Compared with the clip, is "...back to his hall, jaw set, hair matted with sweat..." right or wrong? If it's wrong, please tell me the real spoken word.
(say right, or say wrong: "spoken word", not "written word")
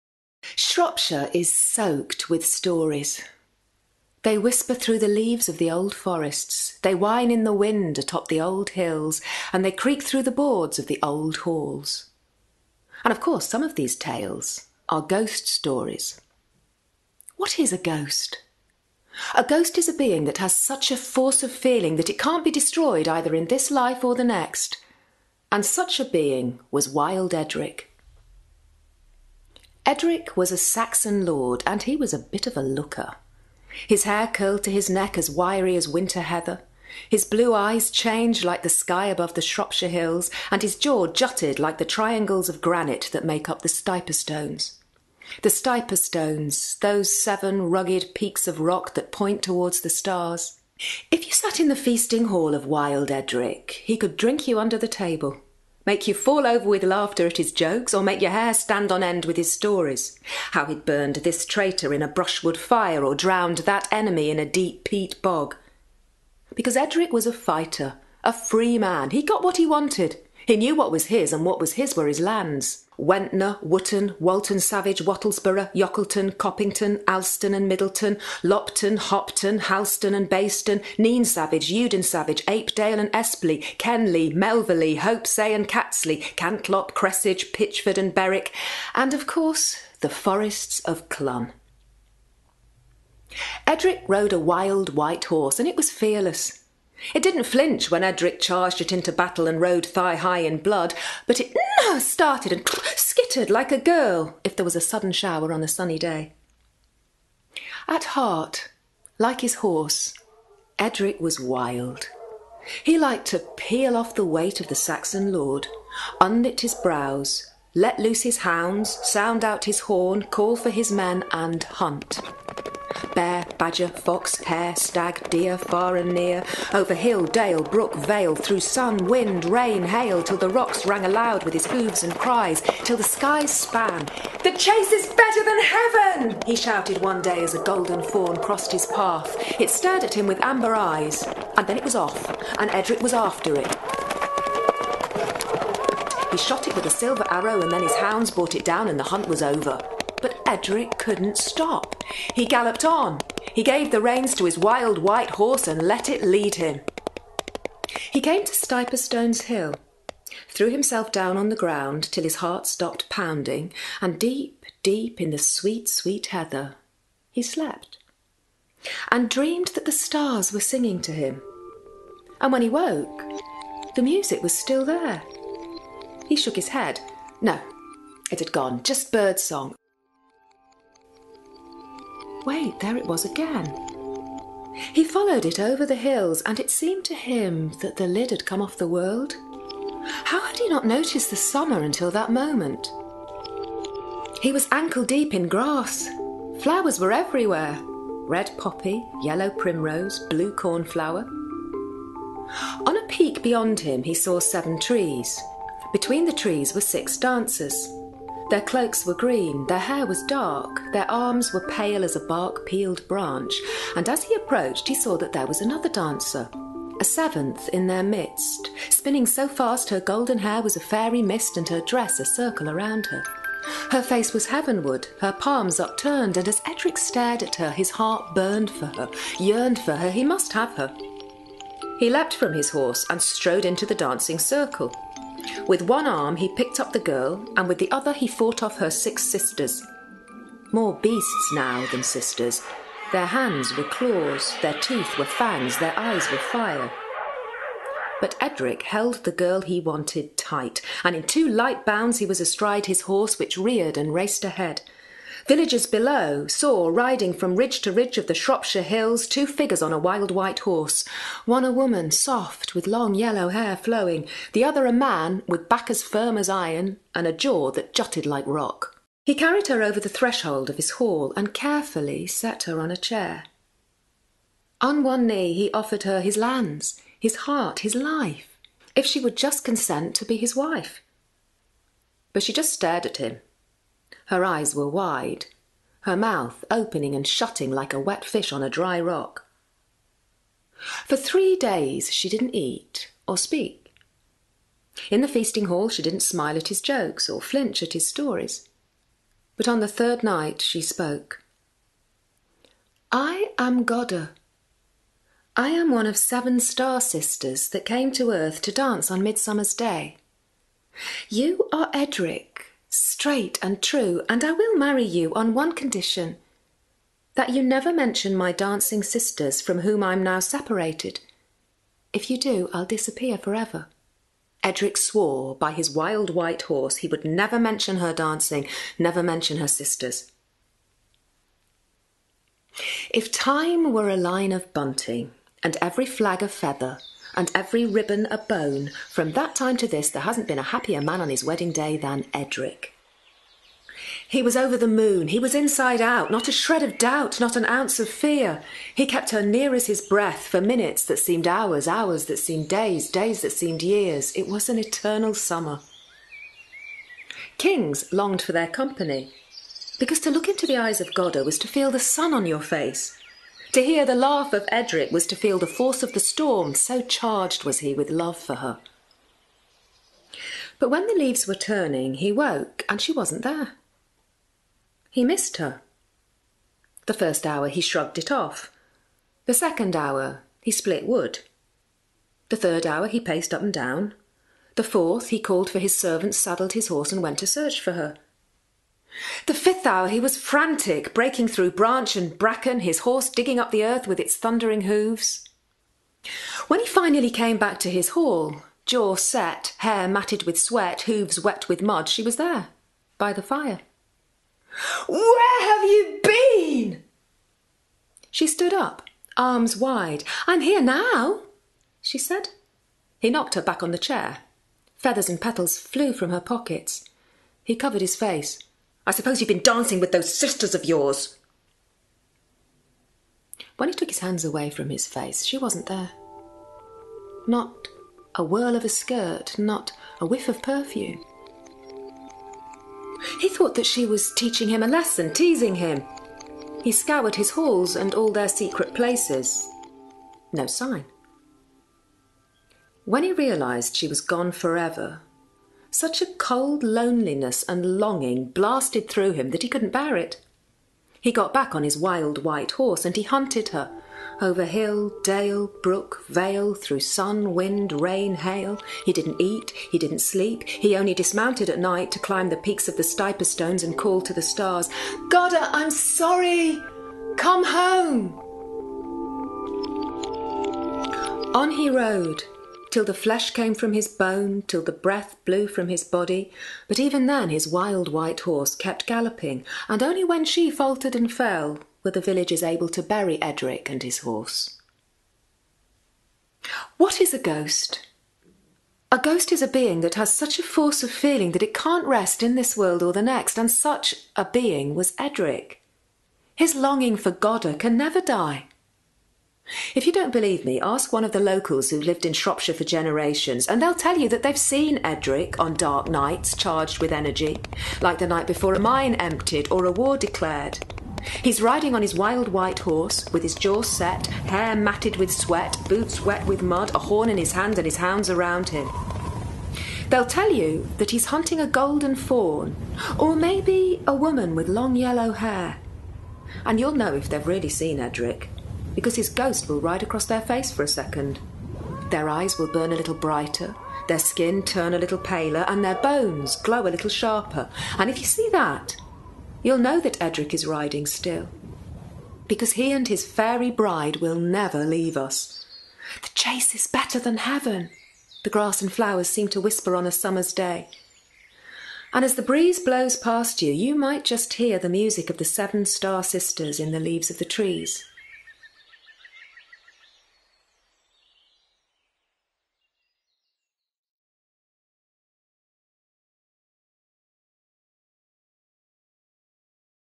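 right.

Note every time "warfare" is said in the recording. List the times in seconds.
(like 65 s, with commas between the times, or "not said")
not said.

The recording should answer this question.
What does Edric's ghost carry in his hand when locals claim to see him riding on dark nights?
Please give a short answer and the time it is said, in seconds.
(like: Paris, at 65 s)
A horn, at 516 s.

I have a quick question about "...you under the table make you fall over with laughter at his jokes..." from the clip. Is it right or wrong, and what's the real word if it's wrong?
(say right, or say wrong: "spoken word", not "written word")
right.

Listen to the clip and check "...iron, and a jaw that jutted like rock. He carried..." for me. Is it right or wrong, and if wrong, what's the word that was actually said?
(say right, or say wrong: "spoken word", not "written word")
right.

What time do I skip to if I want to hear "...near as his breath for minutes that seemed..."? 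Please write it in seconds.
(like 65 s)
349 s.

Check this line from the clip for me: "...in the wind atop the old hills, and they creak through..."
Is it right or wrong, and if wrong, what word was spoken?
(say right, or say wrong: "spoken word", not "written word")
right.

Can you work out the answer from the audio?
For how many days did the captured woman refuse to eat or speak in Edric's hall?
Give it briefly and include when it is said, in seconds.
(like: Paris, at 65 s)
3, at 291 s.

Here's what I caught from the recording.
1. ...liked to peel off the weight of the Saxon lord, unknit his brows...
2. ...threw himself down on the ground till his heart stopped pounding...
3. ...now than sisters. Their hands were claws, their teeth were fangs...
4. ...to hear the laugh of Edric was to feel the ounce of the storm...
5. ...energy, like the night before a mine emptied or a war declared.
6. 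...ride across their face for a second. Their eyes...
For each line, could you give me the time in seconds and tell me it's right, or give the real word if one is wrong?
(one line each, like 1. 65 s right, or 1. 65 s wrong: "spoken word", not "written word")
1. 112 s right
2. 160 s right
3. 241 s right
4. 363 s wrong: "force", not "ounce"
5. 507 s right
6. 529 s right.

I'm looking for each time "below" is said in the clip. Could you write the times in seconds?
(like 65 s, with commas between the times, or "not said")
255 s.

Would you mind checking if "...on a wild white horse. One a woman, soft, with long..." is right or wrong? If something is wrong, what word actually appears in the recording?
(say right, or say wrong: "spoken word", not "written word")
right.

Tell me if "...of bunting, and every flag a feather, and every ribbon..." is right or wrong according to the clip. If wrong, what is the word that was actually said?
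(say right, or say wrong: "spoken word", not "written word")
right.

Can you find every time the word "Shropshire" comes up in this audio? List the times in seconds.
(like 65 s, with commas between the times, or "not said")
0 s, 39 s, 258 s, 502 s.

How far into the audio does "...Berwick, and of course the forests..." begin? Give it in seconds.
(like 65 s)
88 s.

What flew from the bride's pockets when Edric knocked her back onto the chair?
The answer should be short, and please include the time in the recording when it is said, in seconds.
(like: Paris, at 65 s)
Feathers and petals, at 414 s.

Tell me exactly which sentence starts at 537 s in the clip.
And if you see that, you'll know that Edric is riding still.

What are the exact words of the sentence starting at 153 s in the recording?
He gave the reins to his wild white horse and let it lead him.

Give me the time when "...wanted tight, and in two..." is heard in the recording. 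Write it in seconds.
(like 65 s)
249 s.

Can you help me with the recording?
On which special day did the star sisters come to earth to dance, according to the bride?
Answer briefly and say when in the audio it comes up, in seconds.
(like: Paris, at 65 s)
Midsummer's Day, at 309 s.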